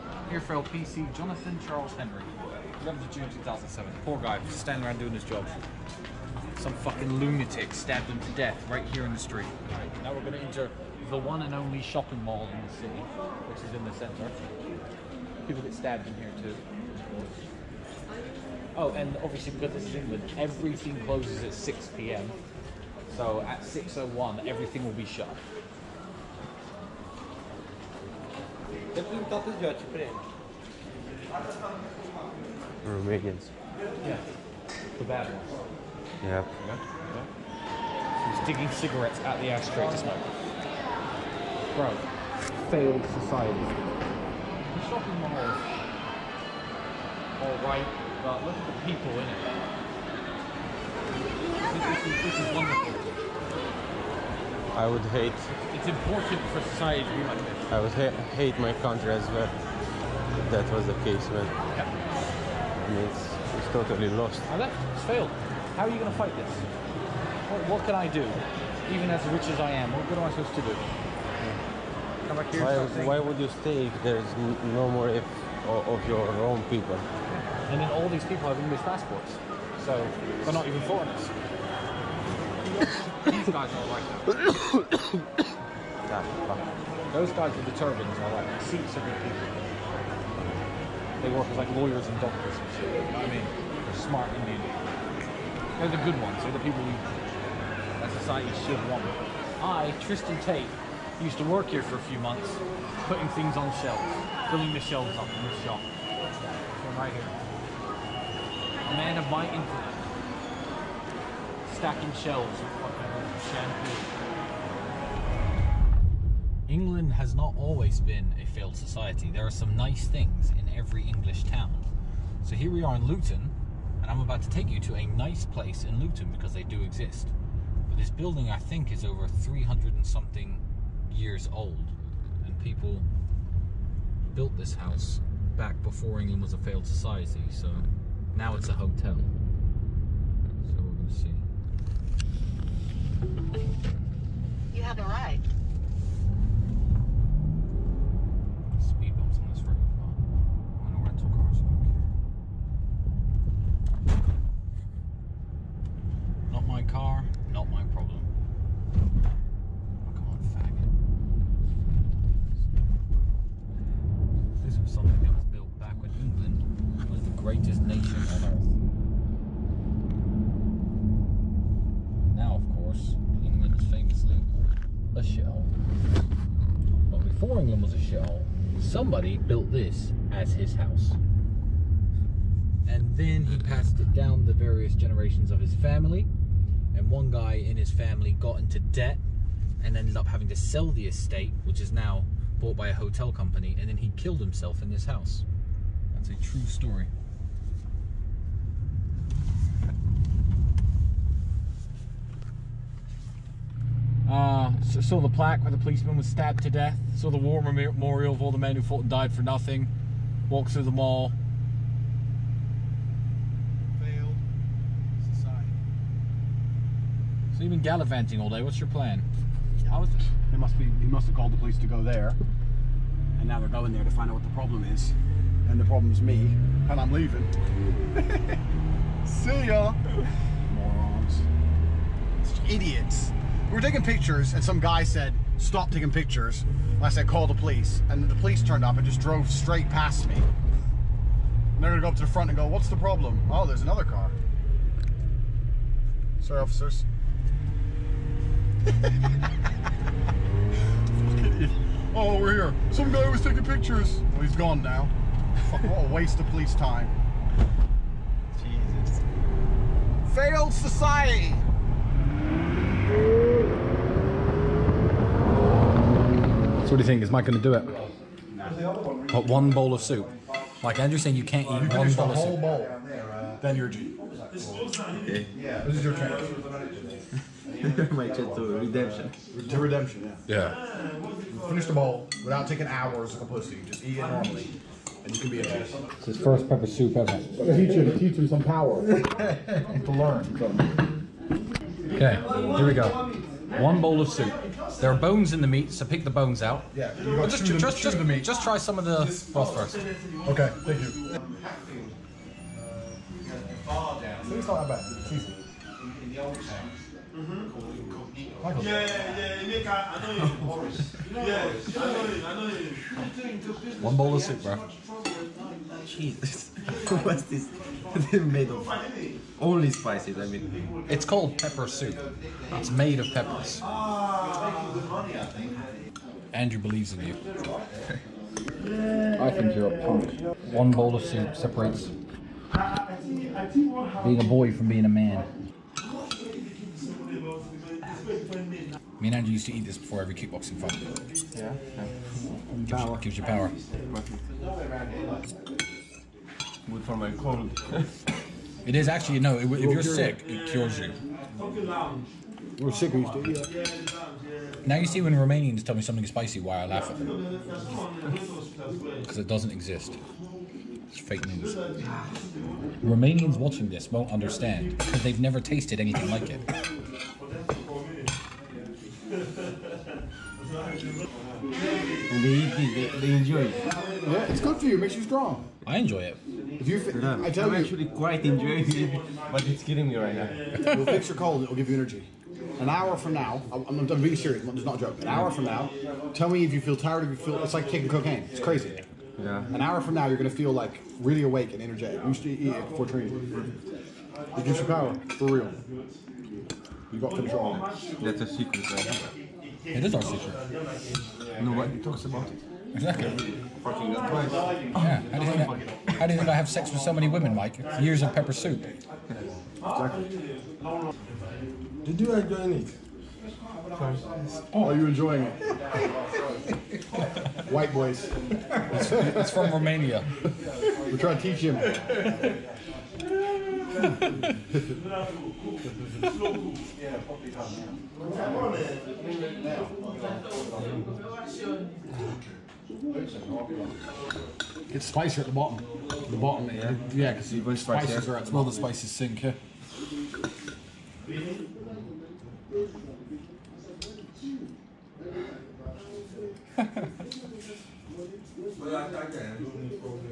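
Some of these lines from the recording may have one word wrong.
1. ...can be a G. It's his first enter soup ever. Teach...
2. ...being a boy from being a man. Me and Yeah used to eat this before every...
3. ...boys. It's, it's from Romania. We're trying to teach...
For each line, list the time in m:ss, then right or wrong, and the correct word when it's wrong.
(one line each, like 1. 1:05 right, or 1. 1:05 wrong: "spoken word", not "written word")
1. 4:45 wrong: "pepper", not "enter"
2. 5:33 wrong: "Andrew", not "Yeah"
3. 6:57 right.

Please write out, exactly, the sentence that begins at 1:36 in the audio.
They're the people that society should want.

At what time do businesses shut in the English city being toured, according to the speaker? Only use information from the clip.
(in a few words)
6 p.m.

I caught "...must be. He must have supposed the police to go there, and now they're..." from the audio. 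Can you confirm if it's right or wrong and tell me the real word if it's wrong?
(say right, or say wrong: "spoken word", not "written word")
wrong: "called", not "supposed".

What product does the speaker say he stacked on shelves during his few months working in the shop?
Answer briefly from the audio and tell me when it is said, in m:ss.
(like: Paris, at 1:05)
Shampoo, at 1:53.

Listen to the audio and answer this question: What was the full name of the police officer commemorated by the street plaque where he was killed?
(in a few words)
Jonathan Charles Henry.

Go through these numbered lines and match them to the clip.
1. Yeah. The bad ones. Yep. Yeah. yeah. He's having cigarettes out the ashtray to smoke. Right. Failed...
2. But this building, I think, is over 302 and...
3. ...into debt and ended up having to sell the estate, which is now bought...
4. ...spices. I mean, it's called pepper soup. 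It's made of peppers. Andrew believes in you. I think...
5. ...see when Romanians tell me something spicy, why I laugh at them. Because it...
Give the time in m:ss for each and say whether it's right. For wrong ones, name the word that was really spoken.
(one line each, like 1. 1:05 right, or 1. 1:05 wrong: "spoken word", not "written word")
1. 0:34 wrong: "digging", not "having"
2. 2:07 wrong: "300", not "302"
3. 3:08 right
4. 5:19 right
5. 5:55 right.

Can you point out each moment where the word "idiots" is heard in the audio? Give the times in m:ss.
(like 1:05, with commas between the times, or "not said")
3:52.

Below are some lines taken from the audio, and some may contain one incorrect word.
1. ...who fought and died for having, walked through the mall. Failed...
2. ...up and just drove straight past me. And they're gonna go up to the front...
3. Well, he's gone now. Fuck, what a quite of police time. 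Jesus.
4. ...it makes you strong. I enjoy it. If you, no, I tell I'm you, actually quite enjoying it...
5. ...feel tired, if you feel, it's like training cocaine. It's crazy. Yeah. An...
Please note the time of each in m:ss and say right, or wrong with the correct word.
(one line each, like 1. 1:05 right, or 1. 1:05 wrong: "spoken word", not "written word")
1. 3:28 wrong: "nothing", not "having"
2. 3:58 right
3. 4:14 wrong: "waste", not "quite"
4. 6:14 right
5. 6:26 wrong: "taking", not "training".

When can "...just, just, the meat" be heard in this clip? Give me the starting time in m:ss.
4:57.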